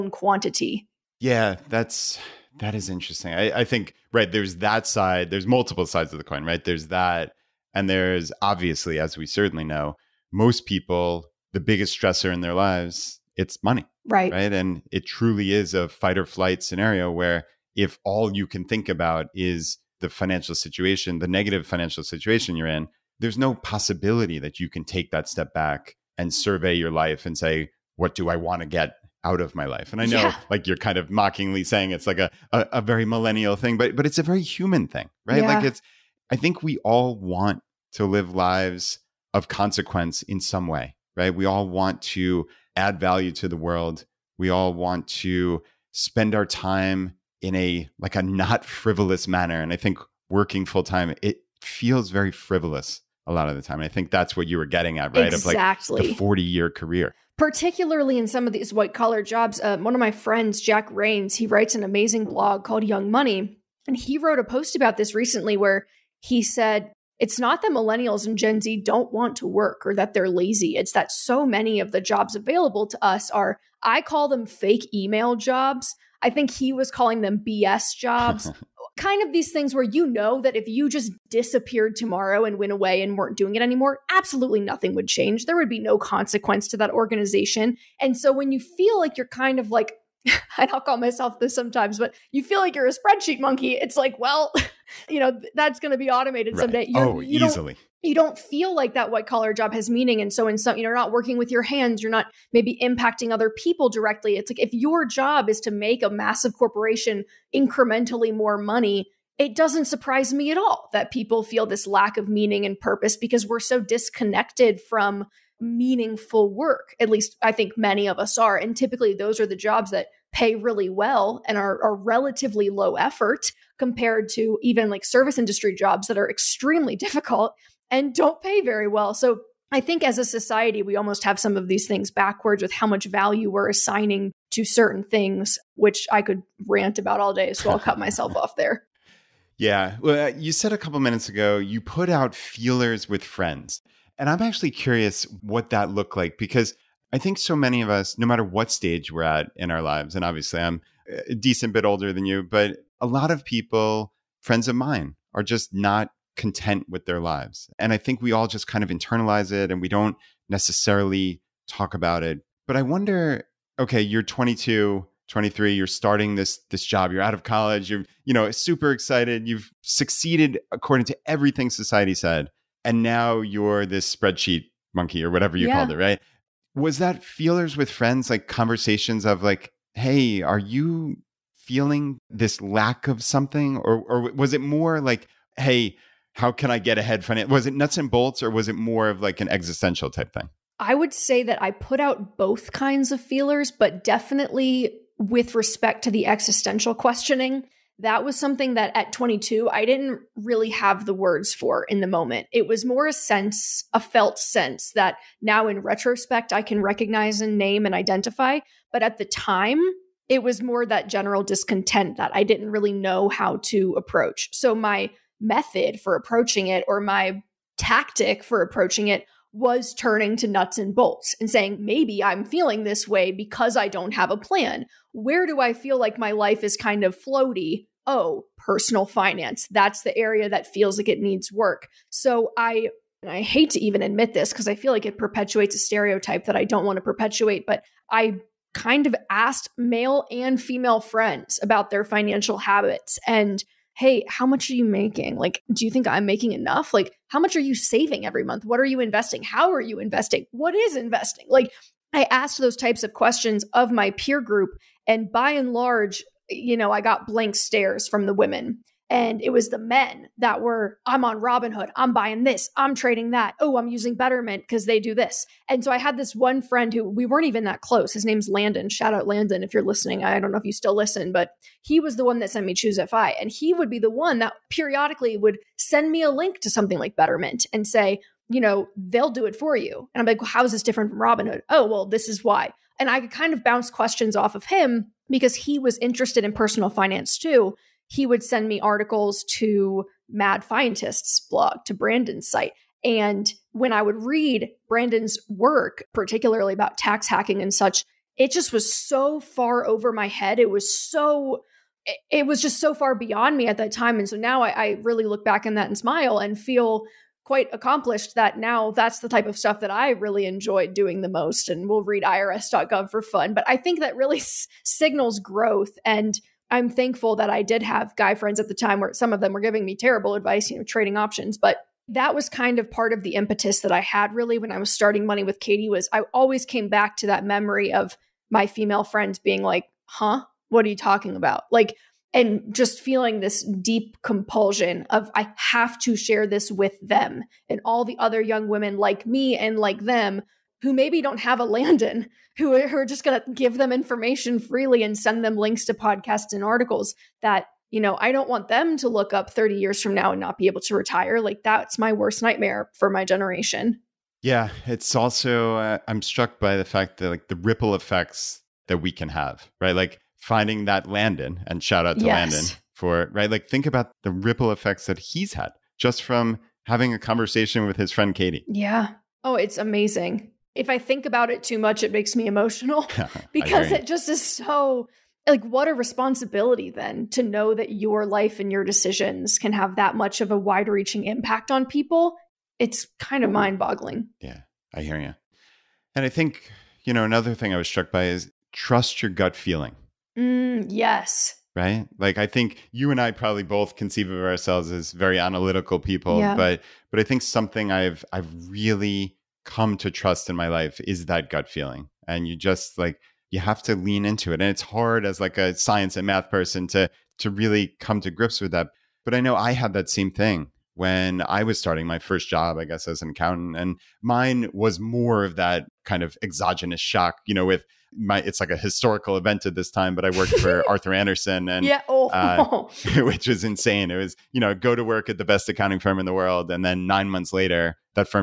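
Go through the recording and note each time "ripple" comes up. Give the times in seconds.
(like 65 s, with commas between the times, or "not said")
357 s, 364 s.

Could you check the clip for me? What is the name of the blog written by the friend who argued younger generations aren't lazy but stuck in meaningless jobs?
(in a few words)
Young Money.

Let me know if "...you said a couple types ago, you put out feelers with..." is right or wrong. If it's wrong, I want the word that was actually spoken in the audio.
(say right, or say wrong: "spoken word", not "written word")
wrong: "minutes", not "types".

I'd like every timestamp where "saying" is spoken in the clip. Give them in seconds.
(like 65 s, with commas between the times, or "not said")
31 s, 221 s.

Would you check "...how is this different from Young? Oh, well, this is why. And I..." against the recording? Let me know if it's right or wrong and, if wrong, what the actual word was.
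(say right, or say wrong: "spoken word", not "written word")
wrong: "Robinhood", not "Young".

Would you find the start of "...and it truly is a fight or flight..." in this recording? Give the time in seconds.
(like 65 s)
14 s.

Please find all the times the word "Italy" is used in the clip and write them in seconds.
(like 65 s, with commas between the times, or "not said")
not said.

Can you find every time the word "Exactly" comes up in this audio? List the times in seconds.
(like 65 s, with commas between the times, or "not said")
55 s.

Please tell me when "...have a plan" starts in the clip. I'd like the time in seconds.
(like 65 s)
224 s.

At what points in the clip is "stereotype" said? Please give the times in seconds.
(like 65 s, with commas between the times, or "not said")
235 s.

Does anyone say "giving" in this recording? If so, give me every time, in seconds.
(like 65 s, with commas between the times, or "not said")
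319 s.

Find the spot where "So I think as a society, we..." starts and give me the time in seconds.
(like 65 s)
129 s.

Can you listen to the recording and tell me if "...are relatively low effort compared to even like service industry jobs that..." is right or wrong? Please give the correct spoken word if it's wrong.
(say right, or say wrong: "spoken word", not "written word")
right.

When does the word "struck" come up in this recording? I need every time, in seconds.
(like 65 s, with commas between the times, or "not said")
356 s, 387 s.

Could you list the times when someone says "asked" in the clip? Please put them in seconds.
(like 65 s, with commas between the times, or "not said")
239 s, 252 s.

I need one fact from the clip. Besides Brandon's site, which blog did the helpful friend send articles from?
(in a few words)
Mad Fientist.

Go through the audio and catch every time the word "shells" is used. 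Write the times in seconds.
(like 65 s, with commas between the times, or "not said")
not said.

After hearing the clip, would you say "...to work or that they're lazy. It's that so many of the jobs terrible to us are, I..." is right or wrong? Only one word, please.
wrong.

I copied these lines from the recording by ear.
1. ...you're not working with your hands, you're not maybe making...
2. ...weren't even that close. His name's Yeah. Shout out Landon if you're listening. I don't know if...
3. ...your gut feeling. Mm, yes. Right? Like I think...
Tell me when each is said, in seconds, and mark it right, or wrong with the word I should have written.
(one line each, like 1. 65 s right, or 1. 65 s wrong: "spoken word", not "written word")
1. 100 s wrong: "impacting", not "making"
2. 267 s wrong: "Landon", not "Yeah"
3. 389 s right.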